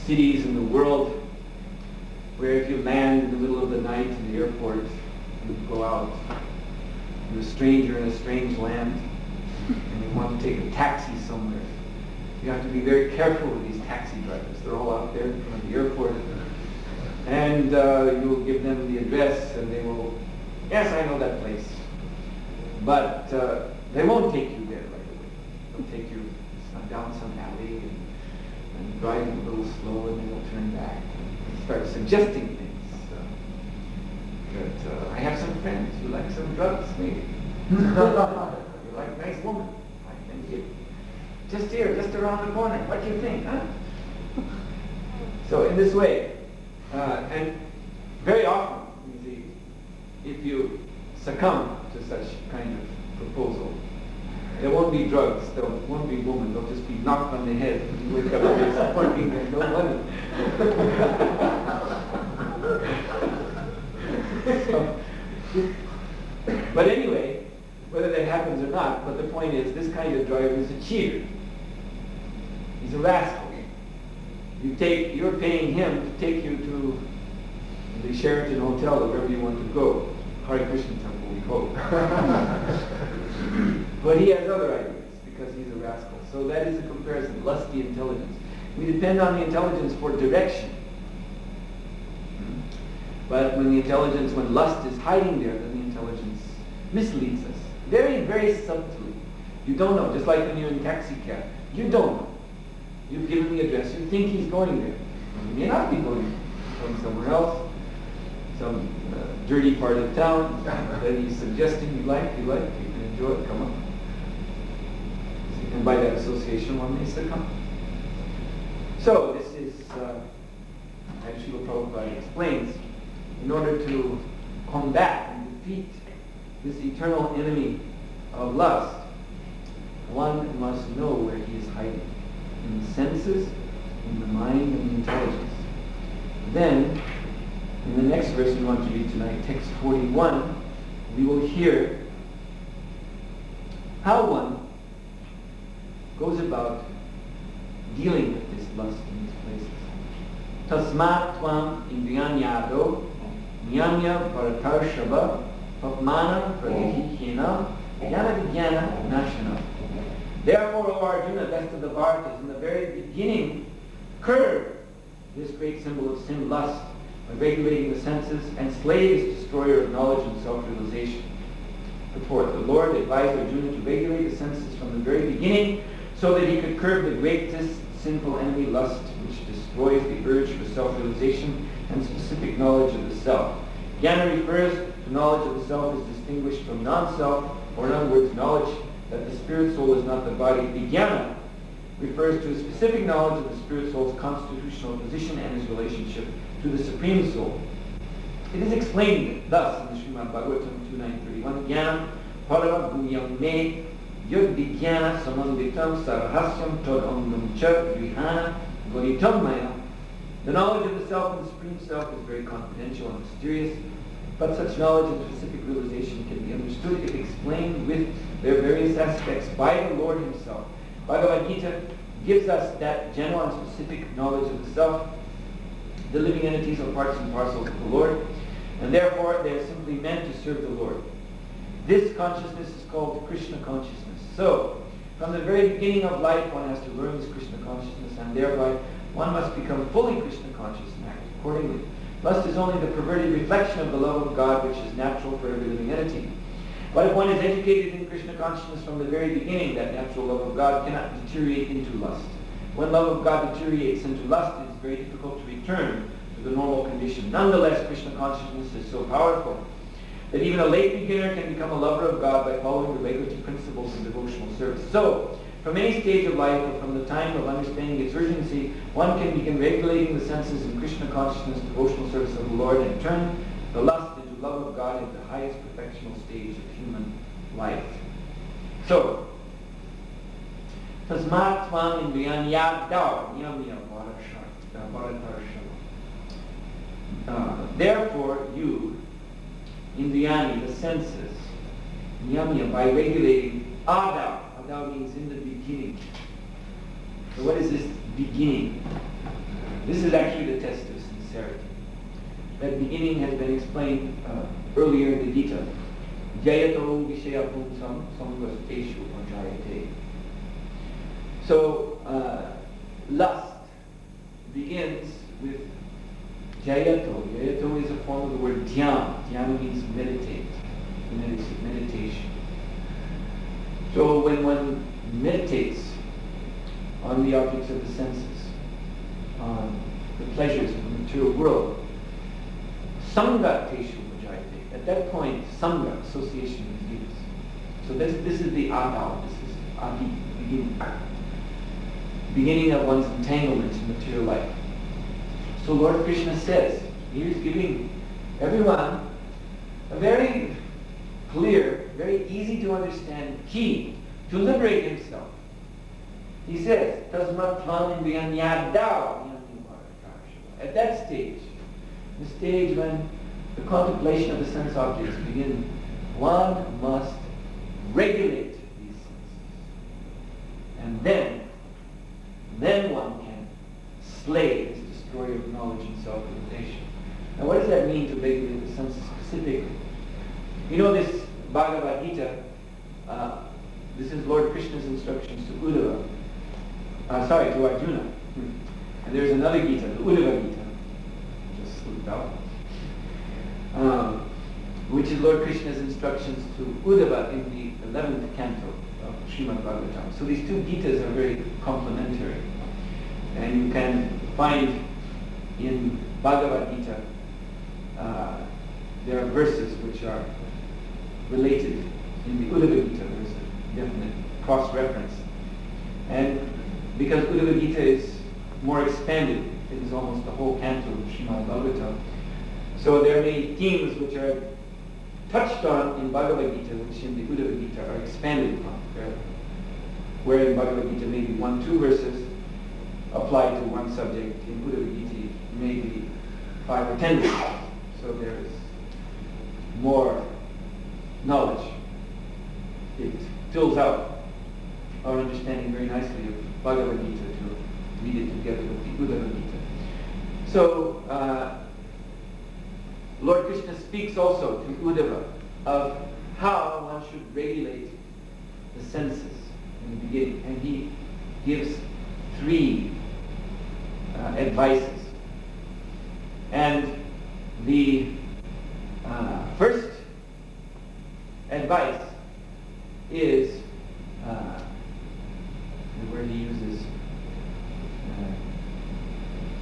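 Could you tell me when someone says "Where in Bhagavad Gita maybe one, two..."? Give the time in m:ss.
7:10.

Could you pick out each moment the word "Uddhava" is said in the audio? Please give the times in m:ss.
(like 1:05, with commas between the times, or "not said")
6:25, 6:29, 6:36, 6:52, 6:57, 7:07, 7:14, 7:34.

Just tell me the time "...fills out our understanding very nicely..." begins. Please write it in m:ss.
7:23.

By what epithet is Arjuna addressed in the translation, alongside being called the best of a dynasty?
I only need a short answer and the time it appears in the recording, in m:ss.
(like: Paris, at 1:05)
best of the Bharatas, at 2:41.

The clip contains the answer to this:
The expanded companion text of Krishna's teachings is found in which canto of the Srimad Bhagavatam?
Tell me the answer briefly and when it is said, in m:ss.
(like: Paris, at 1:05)
11th canto, at 6:37.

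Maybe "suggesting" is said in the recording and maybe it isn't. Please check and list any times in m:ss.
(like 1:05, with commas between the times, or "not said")
0:31, 1:51.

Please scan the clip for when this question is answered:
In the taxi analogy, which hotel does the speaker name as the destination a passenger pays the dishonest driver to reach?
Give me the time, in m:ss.
1:18.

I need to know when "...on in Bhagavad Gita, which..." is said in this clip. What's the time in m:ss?
7:05.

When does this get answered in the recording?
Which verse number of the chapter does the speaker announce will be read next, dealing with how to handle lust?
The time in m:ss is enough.
2:19.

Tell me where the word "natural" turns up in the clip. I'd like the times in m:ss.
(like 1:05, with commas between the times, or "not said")
4:04, 4:09.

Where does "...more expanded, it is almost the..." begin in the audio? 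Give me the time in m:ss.
6:58.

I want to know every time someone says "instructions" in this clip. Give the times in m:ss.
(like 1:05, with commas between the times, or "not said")
6:24, 6:35.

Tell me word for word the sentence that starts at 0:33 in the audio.
Uh, that, uh, I have some friends who like some drugs, maybe.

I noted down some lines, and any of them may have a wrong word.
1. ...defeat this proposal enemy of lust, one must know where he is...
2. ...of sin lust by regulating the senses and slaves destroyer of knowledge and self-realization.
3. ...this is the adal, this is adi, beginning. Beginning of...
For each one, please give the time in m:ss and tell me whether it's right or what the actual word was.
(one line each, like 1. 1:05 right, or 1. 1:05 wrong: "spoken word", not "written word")
1. 2:05 wrong: "eternal", not "proposal"
2. 2:46 right
3. 5:38 right.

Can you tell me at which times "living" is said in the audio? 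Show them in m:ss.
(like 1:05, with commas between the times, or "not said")
3:46, 4:05.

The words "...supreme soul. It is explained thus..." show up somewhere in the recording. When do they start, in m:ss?
3:16.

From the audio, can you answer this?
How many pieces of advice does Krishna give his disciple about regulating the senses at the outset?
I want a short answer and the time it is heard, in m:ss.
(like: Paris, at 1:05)
3, at 7:42.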